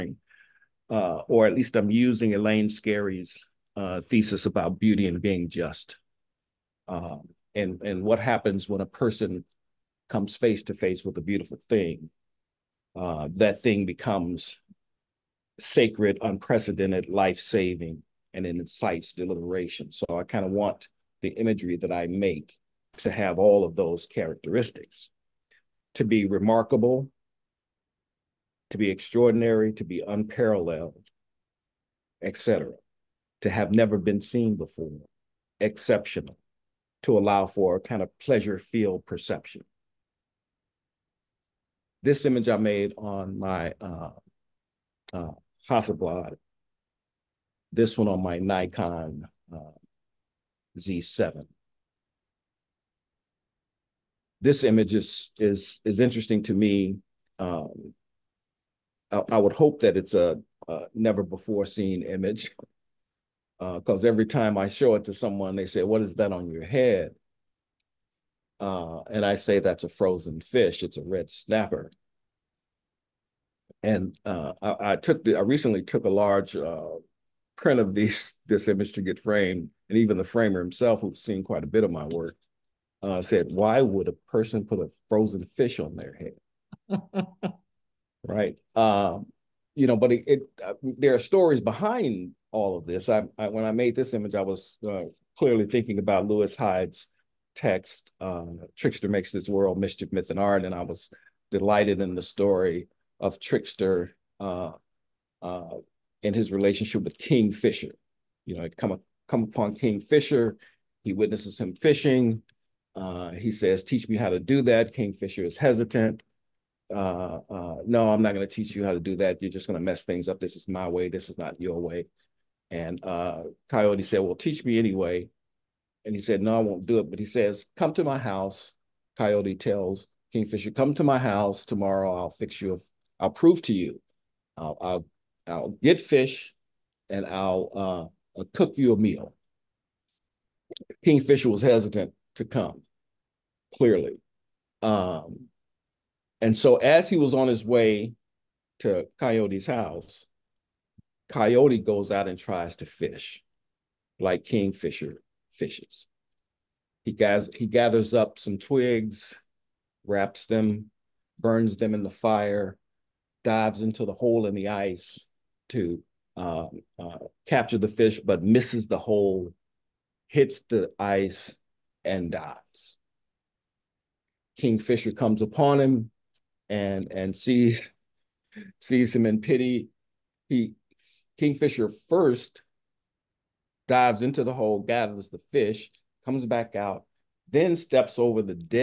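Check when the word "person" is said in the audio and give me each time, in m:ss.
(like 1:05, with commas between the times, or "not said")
0:08, 1:24.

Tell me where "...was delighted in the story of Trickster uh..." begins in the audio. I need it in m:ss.
1:40.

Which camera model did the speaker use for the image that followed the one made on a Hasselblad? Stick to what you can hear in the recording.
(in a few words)
Nikon Z7.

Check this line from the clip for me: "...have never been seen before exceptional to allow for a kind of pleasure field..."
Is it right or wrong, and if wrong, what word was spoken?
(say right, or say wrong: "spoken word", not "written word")
right.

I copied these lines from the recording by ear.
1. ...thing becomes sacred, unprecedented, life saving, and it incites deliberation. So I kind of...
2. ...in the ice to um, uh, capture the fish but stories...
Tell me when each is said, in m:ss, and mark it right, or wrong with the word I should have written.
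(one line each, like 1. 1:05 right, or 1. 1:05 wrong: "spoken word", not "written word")
1. 0:13 right
2. 2:44 wrong: "misses", not "stories".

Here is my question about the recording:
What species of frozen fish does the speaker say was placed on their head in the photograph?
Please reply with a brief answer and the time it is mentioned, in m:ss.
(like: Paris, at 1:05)
Red snapper, at 1:11.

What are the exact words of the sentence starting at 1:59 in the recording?
You're just going to mess things up.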